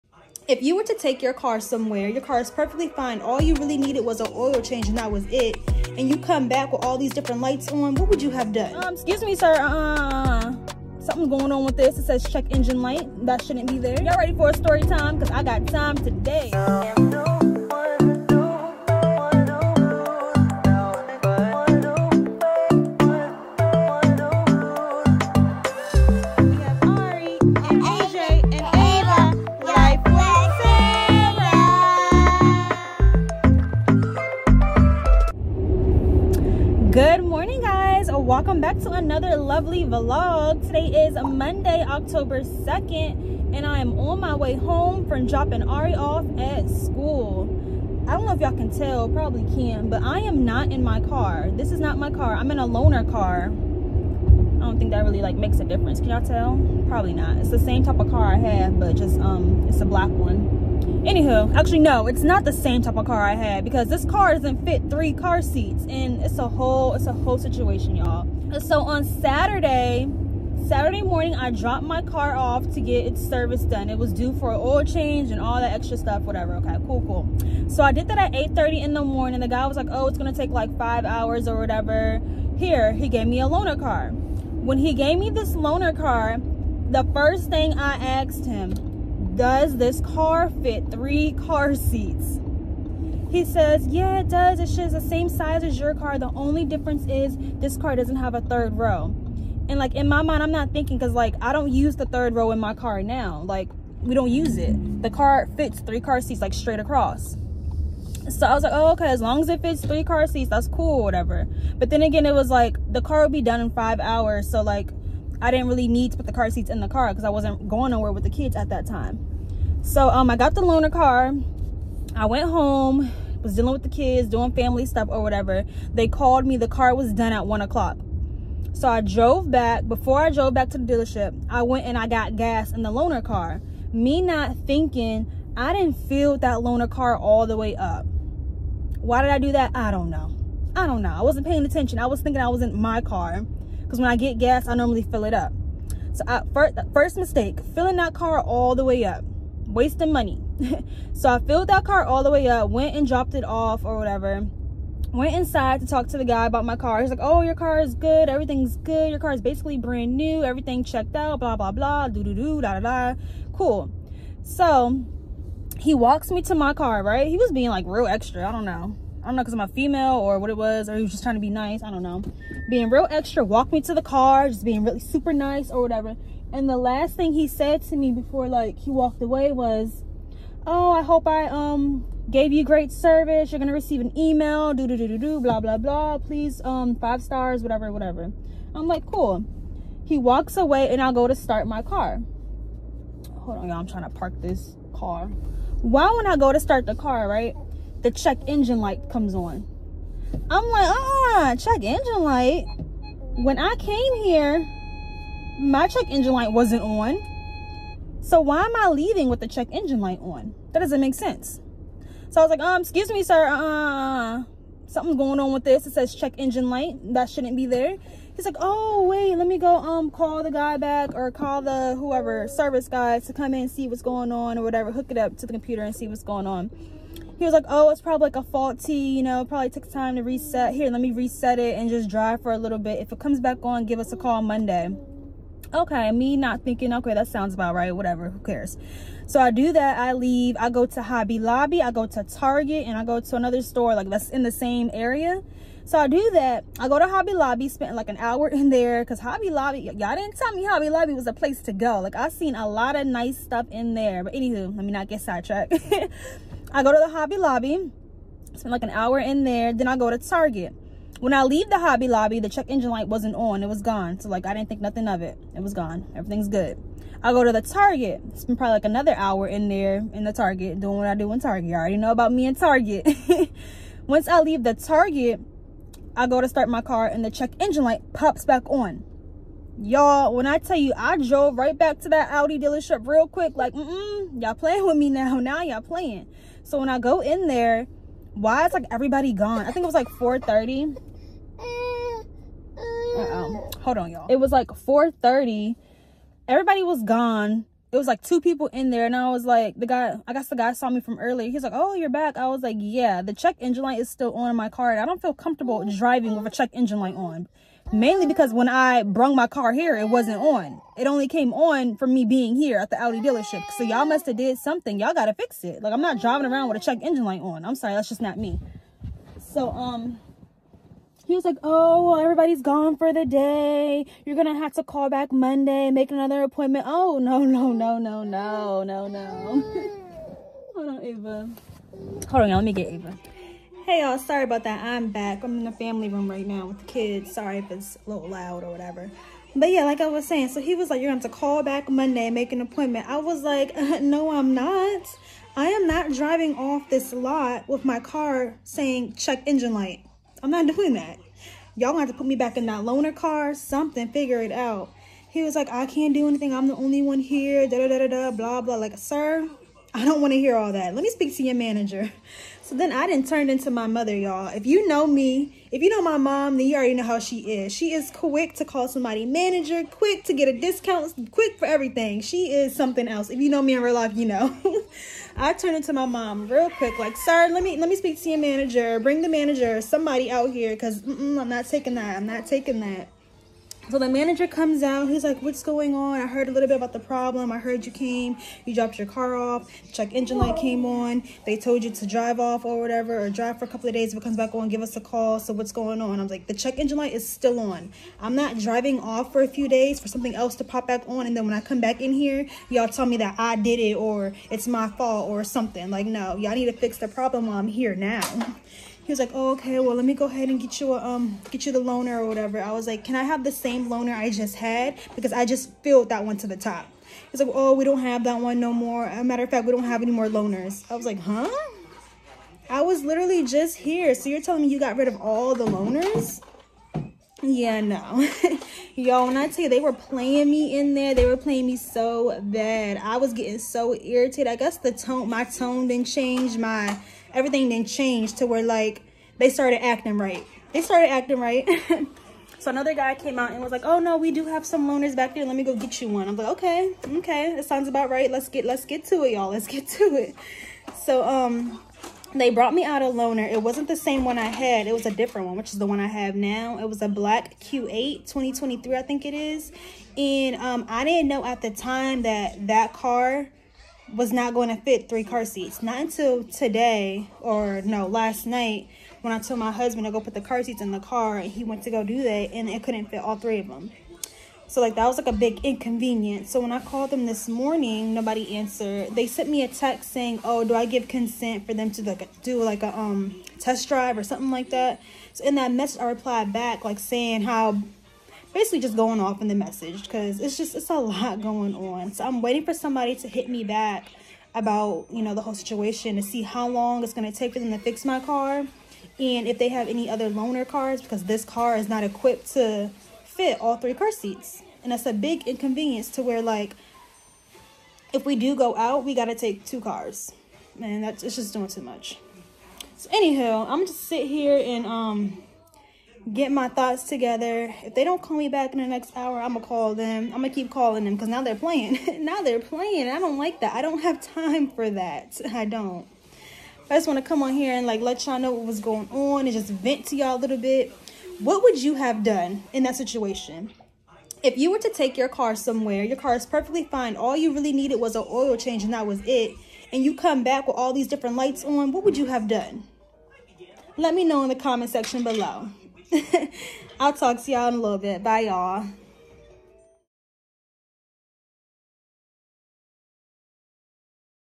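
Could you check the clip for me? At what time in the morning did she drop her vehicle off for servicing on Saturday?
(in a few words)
8:30.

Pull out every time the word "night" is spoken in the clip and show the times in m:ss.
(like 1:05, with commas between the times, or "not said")
7:48.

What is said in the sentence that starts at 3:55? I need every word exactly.
Okay, me not thinking, okay, that sounds about right, whatever, who cares.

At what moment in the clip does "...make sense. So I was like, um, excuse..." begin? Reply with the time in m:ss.
3:31.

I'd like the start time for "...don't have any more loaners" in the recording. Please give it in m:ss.
6:59.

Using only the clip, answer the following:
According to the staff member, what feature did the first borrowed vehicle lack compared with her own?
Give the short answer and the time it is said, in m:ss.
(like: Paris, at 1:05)
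a third row, at 1:38.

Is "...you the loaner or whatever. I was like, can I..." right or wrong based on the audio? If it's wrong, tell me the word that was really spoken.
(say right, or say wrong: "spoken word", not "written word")
right.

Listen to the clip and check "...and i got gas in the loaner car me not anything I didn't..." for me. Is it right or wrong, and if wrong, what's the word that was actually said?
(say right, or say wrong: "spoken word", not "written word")
wrong: "thinking", not "anything".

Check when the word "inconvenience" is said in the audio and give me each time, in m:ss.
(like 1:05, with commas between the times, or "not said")
7:55, 8:25.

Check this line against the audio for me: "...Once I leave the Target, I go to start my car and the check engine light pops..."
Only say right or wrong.
right.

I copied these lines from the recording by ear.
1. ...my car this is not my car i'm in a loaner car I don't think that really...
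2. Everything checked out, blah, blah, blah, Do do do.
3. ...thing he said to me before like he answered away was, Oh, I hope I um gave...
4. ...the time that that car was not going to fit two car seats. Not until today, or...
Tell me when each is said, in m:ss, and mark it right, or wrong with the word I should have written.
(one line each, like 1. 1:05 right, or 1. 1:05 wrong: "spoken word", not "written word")
1. 0:50 right
2. 2:40 right
3. 2:57 wrong: "walked", not "answered"
4. 7:41 wrong: "three", not "two".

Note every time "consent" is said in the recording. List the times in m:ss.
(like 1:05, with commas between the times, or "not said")
8:01.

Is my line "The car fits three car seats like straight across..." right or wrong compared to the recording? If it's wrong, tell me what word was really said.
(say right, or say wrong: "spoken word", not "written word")
right.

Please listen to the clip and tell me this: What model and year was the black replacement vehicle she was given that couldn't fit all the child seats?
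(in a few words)
Q8 2023.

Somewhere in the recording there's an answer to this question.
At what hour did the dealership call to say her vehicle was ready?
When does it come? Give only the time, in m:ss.
2:07.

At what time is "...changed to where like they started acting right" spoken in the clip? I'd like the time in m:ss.
7:17.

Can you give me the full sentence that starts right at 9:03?
Let me know in the comment section below.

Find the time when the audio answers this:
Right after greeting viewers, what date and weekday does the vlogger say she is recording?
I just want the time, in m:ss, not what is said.
0:41.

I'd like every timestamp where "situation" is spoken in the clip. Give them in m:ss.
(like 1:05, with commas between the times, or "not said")
1:07, 8:15, 8:52.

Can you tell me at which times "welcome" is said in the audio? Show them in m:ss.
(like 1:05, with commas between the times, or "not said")
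0:38.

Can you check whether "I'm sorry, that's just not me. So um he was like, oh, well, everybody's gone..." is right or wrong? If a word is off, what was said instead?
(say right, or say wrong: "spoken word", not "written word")
right.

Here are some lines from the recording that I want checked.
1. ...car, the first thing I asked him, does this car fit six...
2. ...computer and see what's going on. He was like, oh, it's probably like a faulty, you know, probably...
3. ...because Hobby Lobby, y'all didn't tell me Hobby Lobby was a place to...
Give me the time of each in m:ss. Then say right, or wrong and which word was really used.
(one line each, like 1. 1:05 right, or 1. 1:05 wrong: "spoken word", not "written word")
1. 1:25 wrong: "three", not "six"
2. 3:45 right
3. 4:09 right.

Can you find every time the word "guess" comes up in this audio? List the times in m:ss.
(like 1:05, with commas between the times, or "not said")
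5:00, 7:14.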